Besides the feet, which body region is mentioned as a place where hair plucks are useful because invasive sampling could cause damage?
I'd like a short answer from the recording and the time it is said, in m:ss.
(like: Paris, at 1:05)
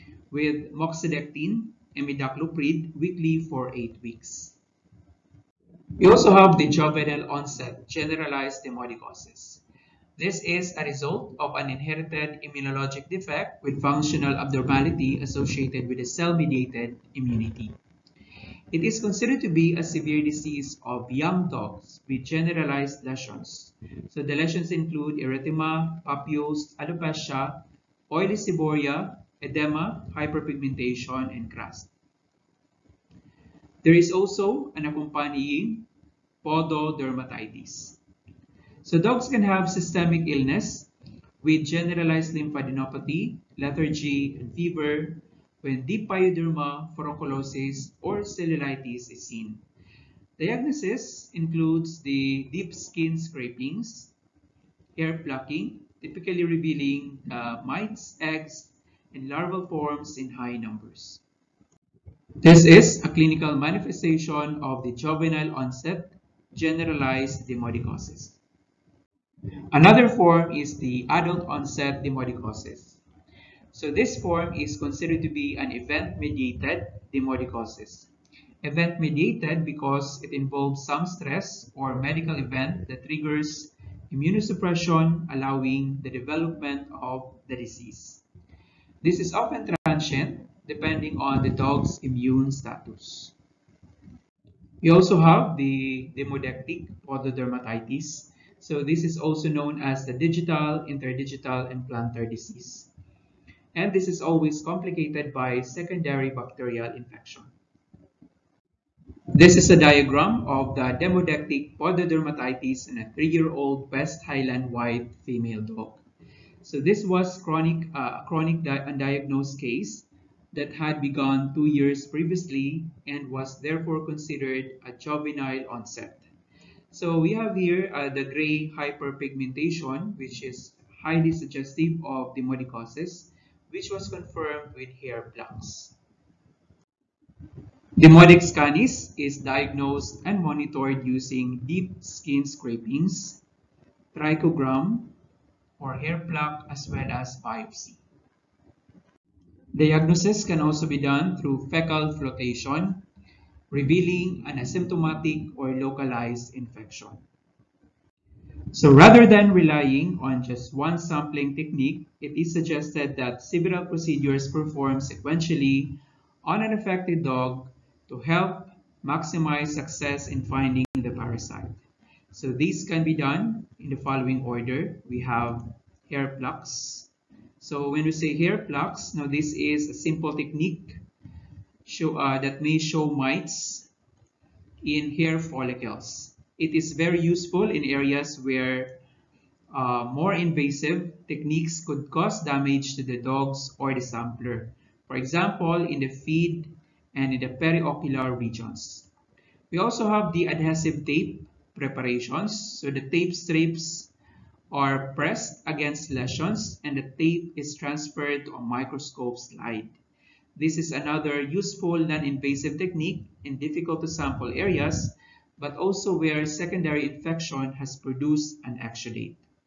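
Periocular regions, at 3:17.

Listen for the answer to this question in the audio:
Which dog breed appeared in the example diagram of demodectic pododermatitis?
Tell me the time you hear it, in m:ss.
1:53.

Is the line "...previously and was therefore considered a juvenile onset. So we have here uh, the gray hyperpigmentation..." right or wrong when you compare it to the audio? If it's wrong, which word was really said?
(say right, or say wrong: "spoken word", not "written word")
right.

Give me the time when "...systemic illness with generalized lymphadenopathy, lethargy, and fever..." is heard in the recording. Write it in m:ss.
0:39.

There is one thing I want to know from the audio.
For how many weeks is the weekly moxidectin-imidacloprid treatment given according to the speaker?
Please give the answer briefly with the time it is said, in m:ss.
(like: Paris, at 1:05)
8 weeks, at 0:03.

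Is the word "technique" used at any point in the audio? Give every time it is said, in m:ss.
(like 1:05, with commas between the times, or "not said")
2:41, 3:00, 3:11, 3:32.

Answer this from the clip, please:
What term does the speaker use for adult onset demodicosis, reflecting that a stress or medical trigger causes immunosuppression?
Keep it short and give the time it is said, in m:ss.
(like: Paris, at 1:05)
Event-mediated demodicosis, at 1:15.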